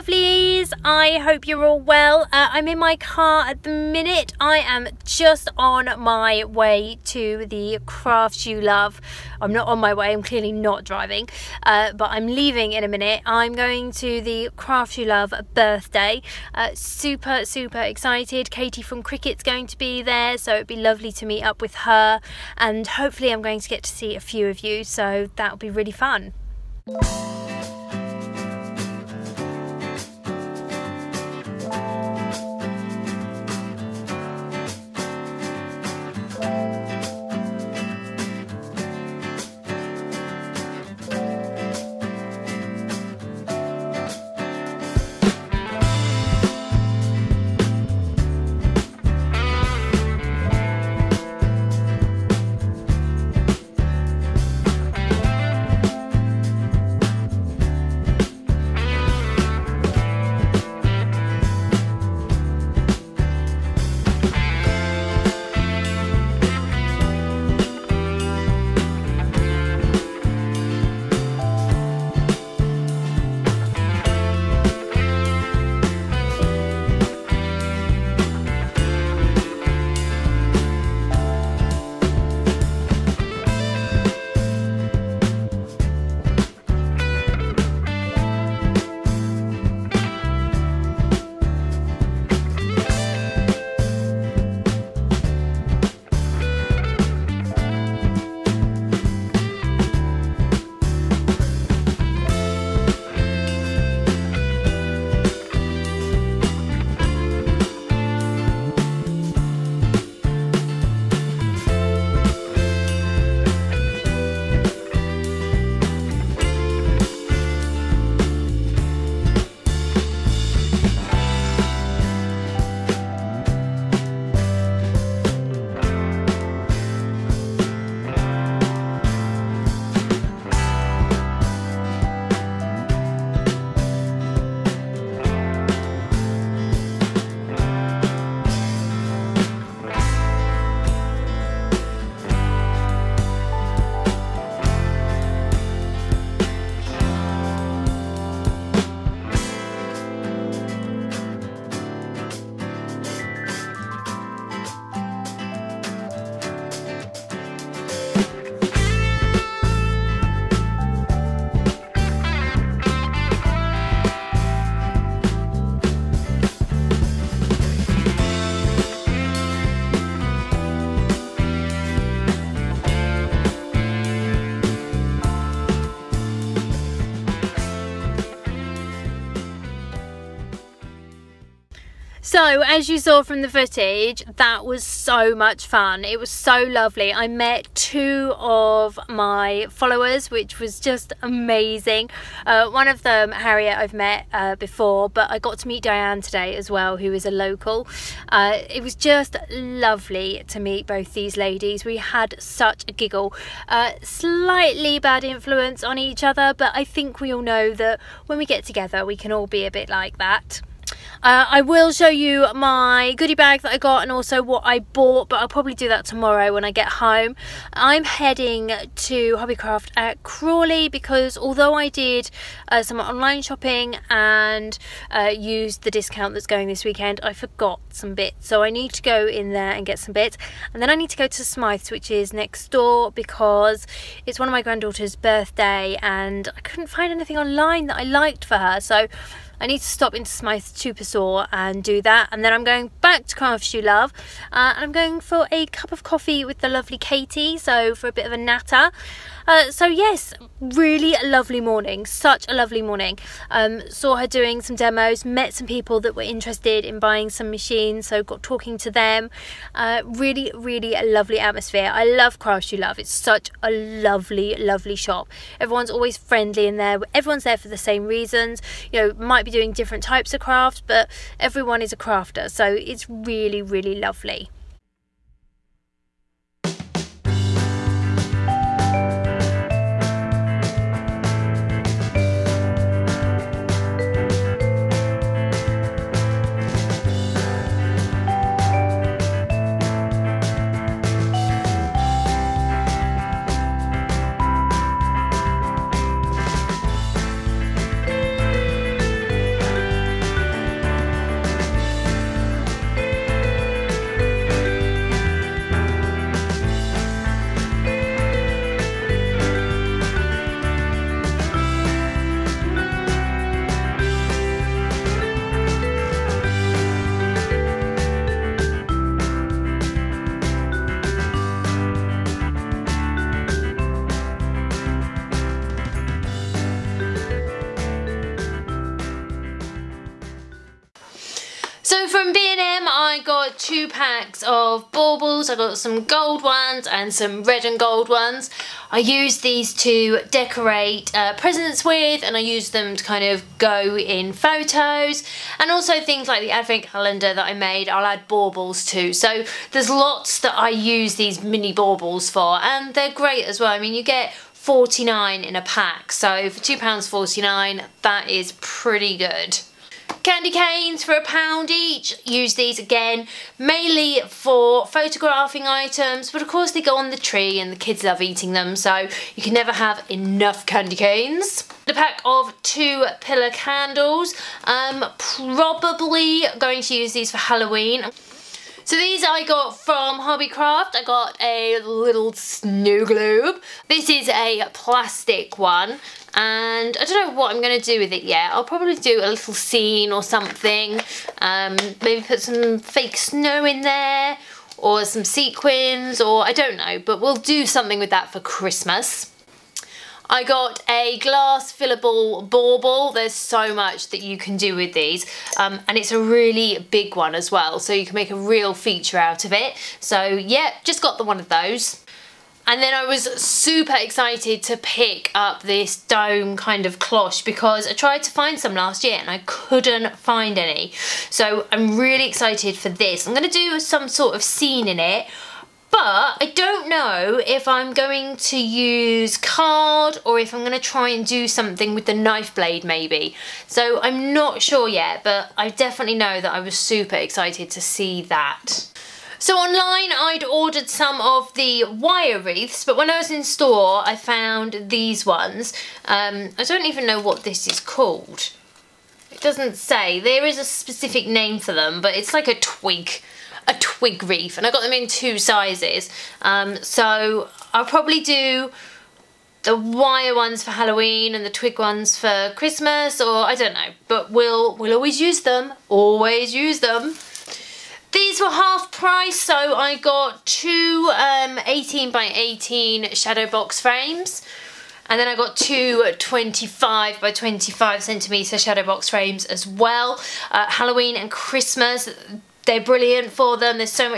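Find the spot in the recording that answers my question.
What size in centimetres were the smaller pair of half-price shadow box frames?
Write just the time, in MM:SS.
07:51.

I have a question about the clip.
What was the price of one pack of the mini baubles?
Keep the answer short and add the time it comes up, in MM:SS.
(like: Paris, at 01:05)
£2.49, at 05:56.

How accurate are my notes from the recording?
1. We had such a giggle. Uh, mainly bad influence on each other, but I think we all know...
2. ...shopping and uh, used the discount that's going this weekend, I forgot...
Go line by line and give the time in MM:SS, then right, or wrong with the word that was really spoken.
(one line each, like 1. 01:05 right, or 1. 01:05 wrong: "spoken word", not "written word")
1. 03:21 wrong: "slightly", not "mainly"
2. 03:43 right.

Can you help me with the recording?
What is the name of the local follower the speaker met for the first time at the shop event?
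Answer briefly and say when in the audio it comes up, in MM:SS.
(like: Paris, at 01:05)
Diane, at 03:15.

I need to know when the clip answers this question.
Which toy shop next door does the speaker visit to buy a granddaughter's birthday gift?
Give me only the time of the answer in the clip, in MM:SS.
03:51.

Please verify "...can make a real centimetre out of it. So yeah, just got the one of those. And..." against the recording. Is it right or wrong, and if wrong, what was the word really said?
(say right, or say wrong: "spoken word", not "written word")
wrong: "feature", not "centimetre".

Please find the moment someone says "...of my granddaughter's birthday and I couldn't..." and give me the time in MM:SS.
03:54.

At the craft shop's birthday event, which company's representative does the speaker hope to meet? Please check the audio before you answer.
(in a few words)
Cricut.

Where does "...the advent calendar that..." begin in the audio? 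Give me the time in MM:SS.
05:46.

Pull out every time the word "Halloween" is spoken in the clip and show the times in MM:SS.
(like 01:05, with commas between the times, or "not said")
06:17, 07:40, 08:00.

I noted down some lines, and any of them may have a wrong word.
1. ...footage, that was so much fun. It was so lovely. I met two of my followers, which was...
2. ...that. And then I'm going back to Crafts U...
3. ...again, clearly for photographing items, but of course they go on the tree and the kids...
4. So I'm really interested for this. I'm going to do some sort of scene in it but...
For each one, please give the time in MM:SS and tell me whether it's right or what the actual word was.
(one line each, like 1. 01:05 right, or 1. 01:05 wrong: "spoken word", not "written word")
1. 03:03 right
2. 04:02 right
3. 06:02 wrong: "mainly", not "clearly"
4. 07:01 wrong: "excited", not "interested".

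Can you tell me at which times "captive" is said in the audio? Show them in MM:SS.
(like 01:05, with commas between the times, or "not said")
not said.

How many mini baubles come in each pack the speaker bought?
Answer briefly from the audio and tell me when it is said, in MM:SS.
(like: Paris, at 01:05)
49, at 05:54.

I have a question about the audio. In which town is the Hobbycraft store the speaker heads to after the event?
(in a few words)
Crawley.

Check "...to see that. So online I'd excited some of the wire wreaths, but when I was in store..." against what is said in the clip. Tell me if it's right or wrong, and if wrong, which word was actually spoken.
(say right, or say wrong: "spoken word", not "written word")
wrong: "ordered", not "excited".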